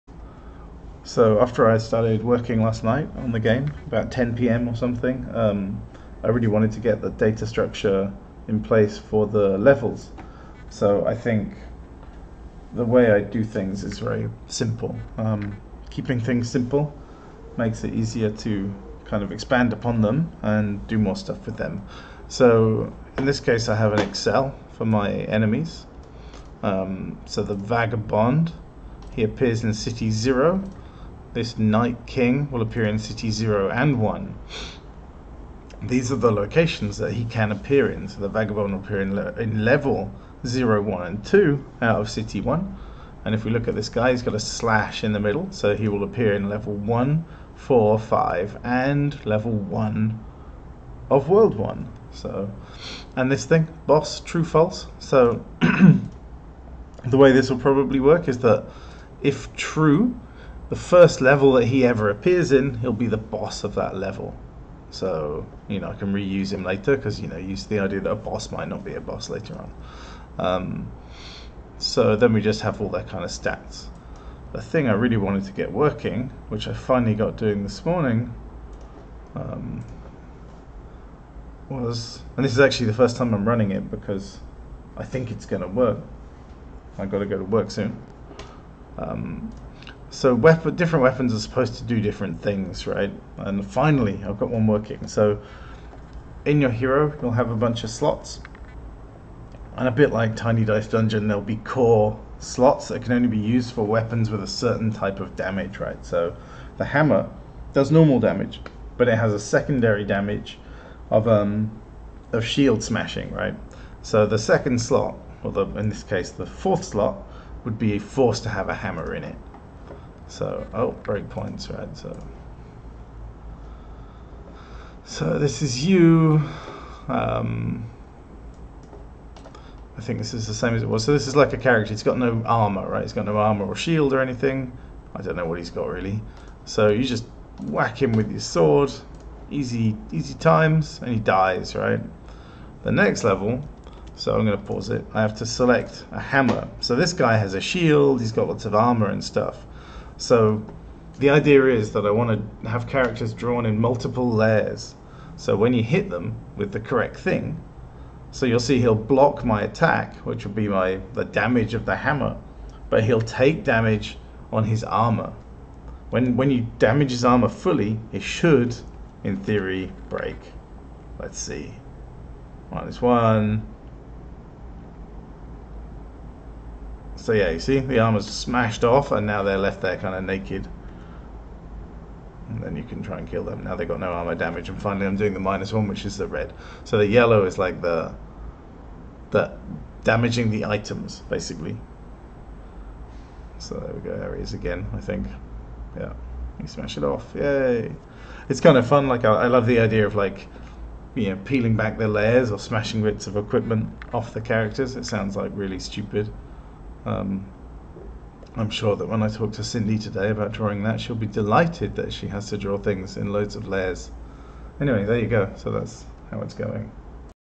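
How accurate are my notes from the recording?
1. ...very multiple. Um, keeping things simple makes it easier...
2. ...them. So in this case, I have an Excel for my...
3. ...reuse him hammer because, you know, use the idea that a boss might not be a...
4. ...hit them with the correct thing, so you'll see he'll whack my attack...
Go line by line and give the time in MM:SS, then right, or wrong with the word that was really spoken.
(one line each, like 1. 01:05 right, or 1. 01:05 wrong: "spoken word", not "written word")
1. 00:13 wrong: "simple", not "multiple"
2. 00:21 right
3. 01:06 wrong: "later", not "hammer"
4. 02:35 wrong: "block", not "whack".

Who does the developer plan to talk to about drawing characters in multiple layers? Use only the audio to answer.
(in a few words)
Cindy.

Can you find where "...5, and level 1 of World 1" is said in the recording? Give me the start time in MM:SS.
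00:47.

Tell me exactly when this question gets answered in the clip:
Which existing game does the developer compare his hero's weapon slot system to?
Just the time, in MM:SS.
01:40.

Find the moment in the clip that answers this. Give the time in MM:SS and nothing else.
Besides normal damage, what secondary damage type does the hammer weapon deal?
01:52.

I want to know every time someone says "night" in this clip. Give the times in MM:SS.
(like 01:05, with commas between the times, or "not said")
00:02, 00:31.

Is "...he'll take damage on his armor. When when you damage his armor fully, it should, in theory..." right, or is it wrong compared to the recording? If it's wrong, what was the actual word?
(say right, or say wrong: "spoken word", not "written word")
right.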